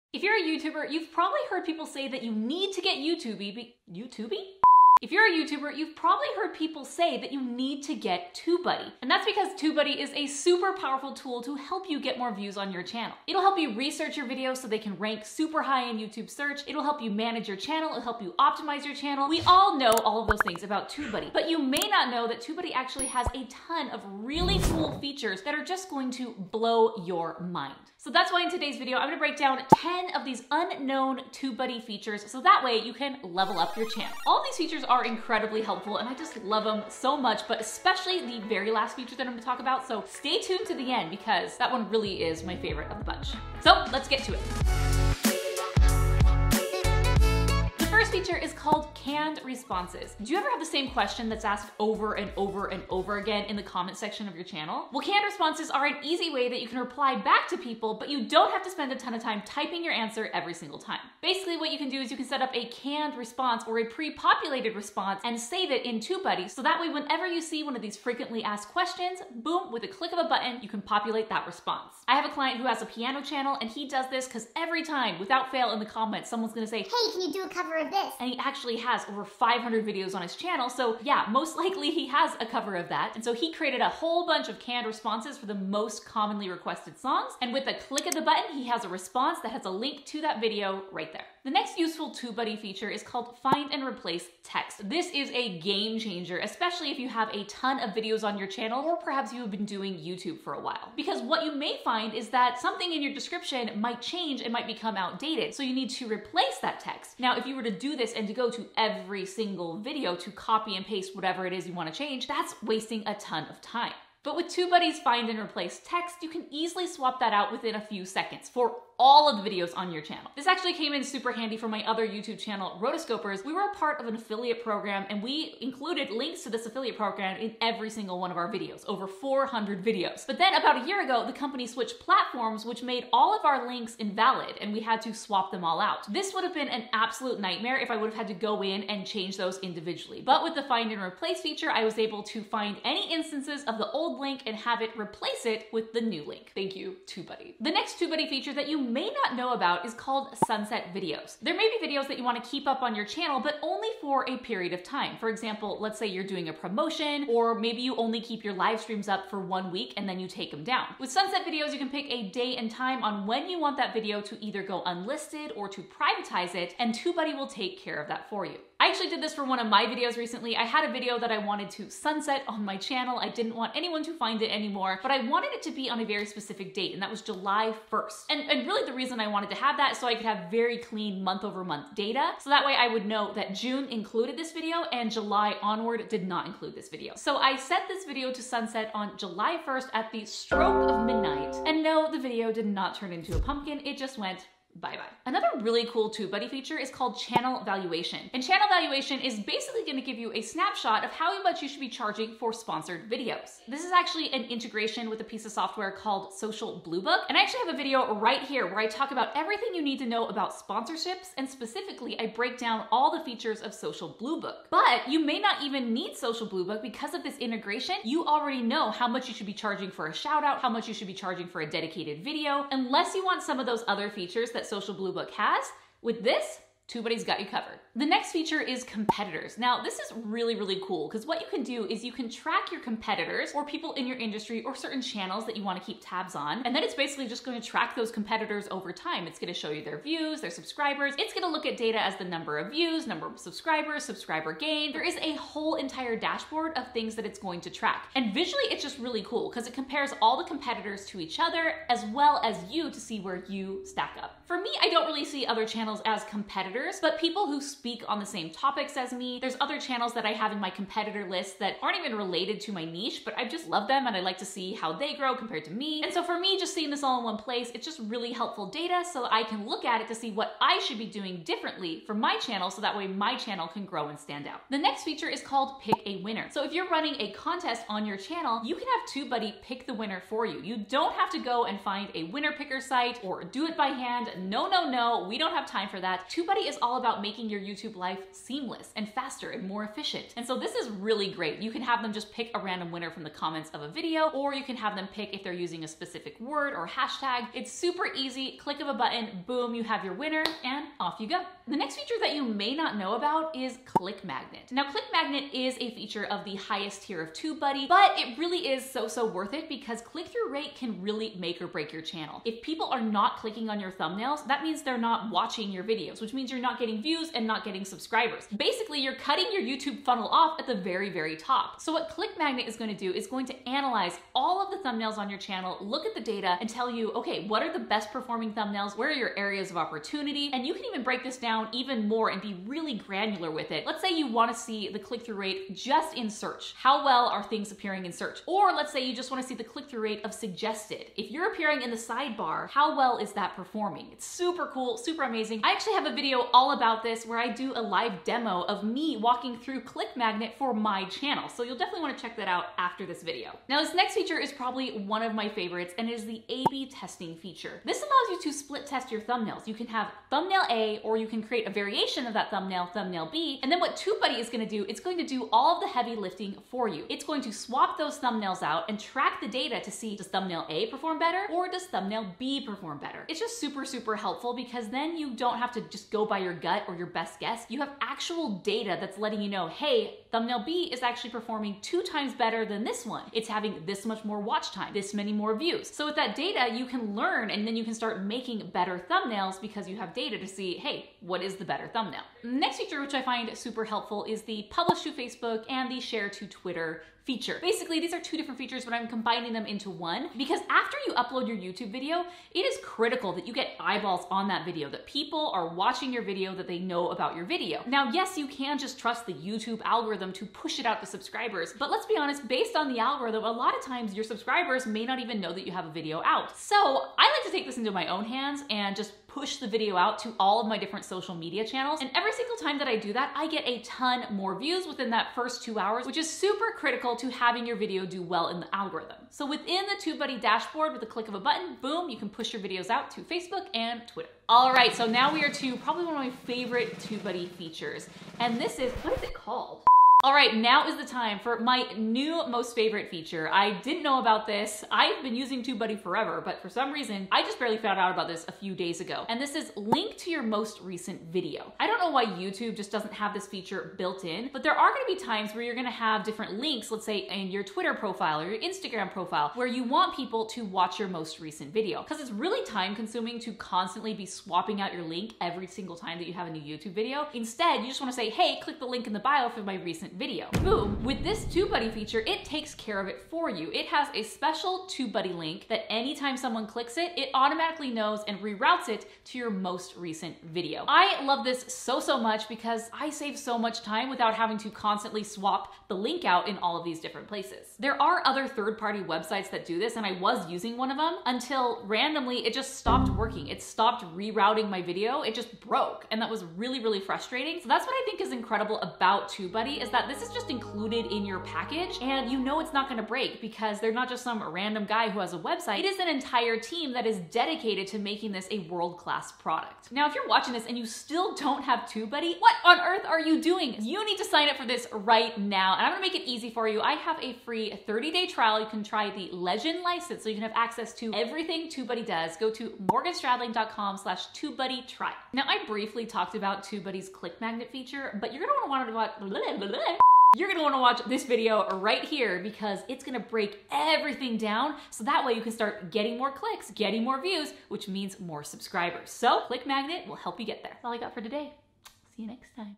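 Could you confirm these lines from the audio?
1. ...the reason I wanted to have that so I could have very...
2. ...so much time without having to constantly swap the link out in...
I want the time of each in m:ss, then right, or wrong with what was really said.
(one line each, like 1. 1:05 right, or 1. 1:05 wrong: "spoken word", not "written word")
1. 2:58 right
2. 8:03 right.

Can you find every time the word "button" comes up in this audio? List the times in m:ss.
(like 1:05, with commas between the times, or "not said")
1:10, 1:28, 4:58, 7:11.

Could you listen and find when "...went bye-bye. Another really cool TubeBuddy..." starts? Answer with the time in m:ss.
3:14.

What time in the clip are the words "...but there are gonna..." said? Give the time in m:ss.
7:34.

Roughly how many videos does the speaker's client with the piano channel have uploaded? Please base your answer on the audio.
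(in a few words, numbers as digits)
over 500.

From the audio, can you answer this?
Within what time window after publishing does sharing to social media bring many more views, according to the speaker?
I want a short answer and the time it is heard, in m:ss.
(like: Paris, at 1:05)
first 2 hours, at 7:05.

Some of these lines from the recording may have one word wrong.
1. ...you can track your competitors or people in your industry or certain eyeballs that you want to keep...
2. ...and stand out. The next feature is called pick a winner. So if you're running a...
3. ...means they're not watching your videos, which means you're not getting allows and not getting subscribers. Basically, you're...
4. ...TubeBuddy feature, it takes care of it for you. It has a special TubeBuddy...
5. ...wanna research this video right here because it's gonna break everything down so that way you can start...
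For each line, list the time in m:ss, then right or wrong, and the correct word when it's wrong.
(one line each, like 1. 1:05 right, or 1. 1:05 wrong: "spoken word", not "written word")
1. 3:52 wrong: "channels", not "eyeballs"
2. 4:34 right
3. 5:14 wrong: "views", not "allows"
4. 7:51 right
5. 8:50 wrong: "watch", not "research".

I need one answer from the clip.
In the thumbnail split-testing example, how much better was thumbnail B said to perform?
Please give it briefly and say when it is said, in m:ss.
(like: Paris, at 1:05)
2 times, at 6:21.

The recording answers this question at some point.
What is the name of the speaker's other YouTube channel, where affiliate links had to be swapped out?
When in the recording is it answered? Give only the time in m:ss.
2:02.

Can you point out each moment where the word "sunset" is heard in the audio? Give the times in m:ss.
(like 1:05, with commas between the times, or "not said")
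2:30, 2:41, 2:51, 3:08.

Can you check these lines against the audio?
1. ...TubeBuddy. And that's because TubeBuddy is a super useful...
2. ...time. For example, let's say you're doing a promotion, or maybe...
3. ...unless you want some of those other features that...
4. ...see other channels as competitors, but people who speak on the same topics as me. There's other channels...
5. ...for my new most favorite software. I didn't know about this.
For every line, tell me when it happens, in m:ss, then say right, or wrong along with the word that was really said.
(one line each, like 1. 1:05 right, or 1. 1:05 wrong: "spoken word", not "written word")
1. 0:08 wrong: "powerful", not "useful"
2. 2:34 right
3. 3:42 right
4. 4:15 right
5. 7:21 wrong: "feature", not "software".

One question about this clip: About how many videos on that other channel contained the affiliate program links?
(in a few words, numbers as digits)
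over 400.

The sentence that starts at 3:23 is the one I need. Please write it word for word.
This is actually an integration with a piece of software called Social Blue Book.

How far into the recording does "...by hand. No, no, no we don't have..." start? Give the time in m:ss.
4:43.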